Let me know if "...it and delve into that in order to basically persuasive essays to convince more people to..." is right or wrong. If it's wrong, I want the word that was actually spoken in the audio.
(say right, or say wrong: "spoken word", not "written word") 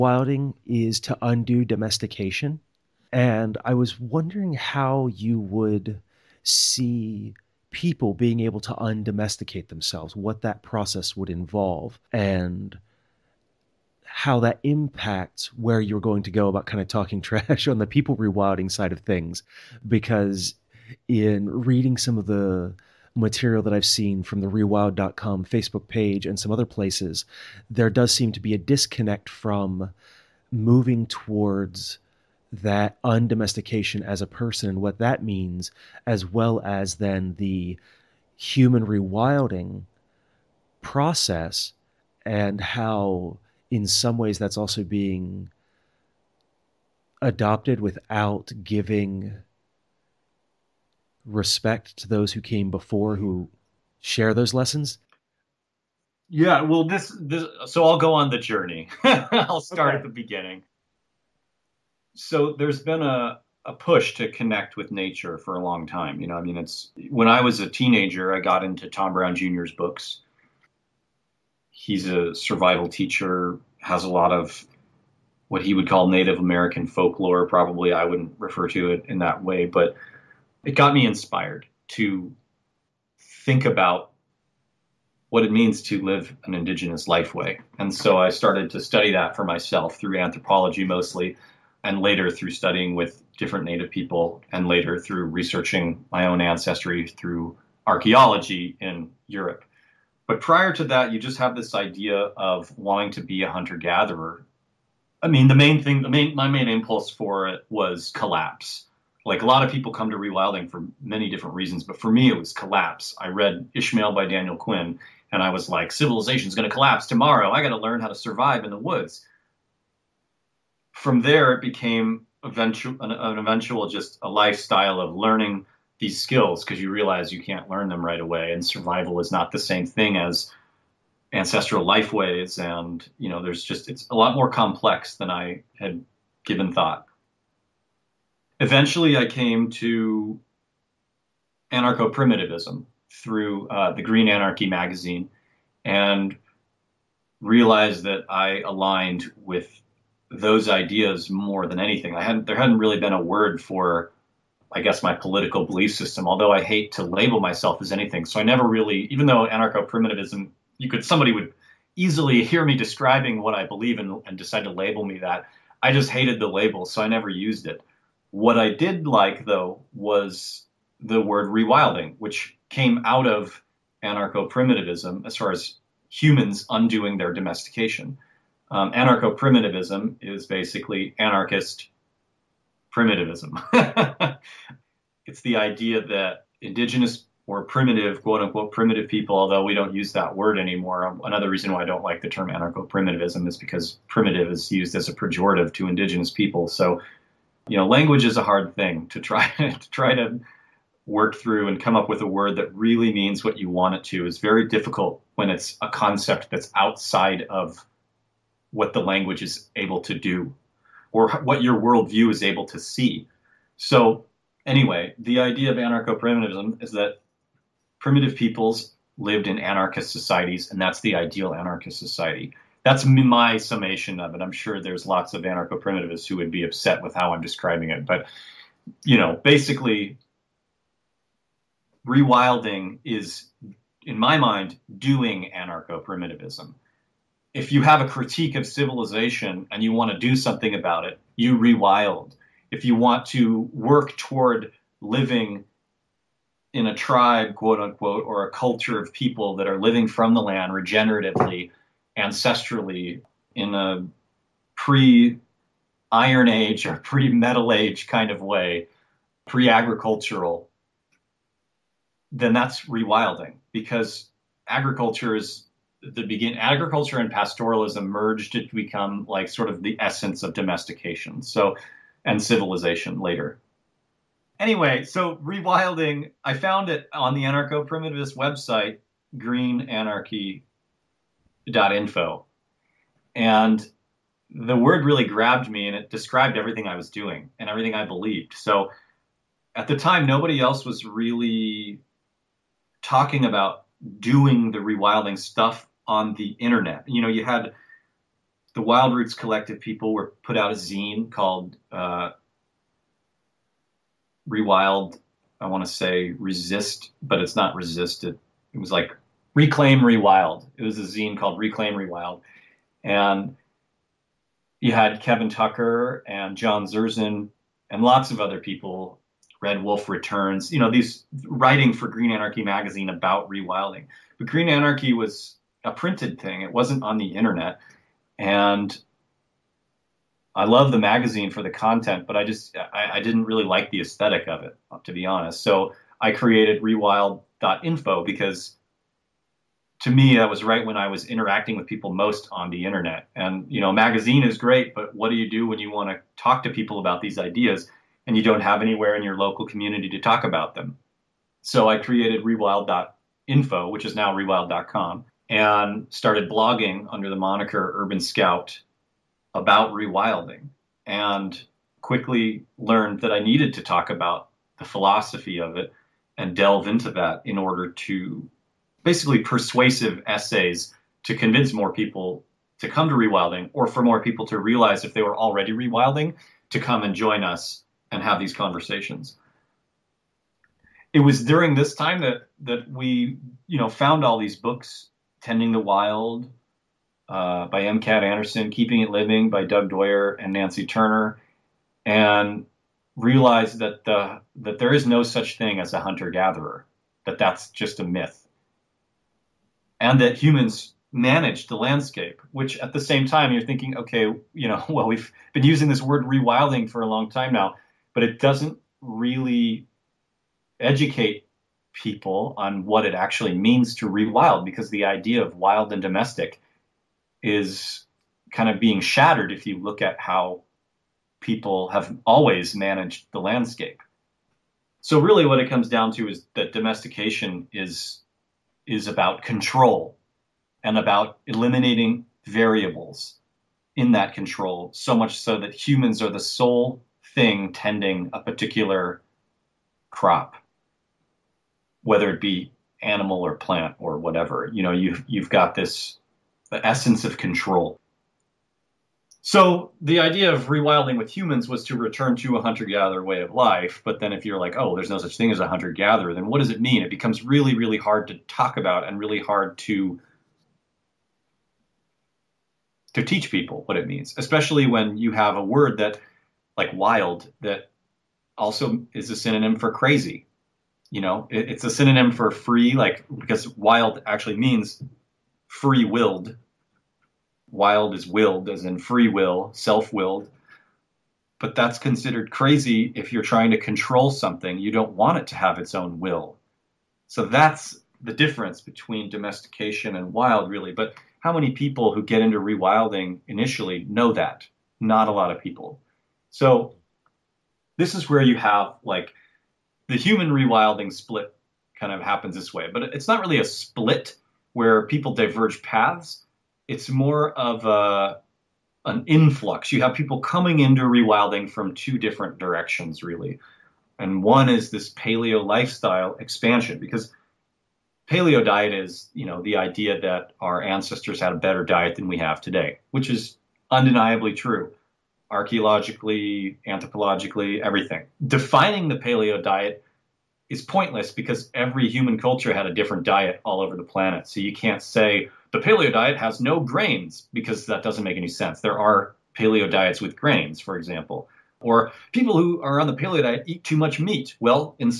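right.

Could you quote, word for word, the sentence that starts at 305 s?
I want to say resist, but it's not resisted.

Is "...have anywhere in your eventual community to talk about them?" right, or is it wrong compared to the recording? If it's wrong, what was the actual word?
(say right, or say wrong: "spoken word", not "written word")
wrong: "local", not "eventual".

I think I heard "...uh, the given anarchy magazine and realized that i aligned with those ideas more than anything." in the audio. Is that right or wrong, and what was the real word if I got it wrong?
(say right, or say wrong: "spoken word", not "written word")
wrong: "green", not "given".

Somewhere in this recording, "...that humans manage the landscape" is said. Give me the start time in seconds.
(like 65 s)
400 s.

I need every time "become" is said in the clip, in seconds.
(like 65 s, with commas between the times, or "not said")
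268 s, 457 s.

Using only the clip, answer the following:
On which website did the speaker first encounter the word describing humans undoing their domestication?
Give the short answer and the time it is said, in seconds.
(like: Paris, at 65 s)
greenanarchy.info, at 279 s.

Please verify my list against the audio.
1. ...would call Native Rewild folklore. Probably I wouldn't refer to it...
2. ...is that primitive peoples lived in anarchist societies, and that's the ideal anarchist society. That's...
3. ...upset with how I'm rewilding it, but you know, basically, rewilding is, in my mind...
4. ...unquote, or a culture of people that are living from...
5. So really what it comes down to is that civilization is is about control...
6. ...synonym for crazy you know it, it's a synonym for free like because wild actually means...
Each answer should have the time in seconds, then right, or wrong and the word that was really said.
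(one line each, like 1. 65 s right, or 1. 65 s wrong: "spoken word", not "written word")
1. 75 s wrong: "American", not "Rewild"
2. 216 s right
3. 226 s wrong: "describing", not "rewilding"
4. 247 s right
5. 425 s wrong: "domestication", not "civilization"
6. 469 s right.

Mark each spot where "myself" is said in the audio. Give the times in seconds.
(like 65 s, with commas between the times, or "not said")
89 s, 157 s.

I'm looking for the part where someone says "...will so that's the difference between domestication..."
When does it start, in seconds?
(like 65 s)
486 s.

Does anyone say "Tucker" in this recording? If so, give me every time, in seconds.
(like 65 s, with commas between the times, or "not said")
315 s.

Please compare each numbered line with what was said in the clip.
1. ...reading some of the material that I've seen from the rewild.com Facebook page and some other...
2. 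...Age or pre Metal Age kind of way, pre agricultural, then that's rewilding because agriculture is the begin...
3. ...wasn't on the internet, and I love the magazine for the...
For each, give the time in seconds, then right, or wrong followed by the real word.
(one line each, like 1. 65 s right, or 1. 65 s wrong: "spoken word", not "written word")
1. 21 s right
2. 256 s right
3. 326 s right.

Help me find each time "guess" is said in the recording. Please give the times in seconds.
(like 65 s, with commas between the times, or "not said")
154 s.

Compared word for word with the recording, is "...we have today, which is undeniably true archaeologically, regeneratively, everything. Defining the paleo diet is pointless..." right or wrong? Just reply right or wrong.
wrong.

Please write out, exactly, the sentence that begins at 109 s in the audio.
Like a lot of people come to rewilding for many different reasons, but for me, it was collapse.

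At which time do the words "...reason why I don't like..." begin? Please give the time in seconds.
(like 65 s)
191 s.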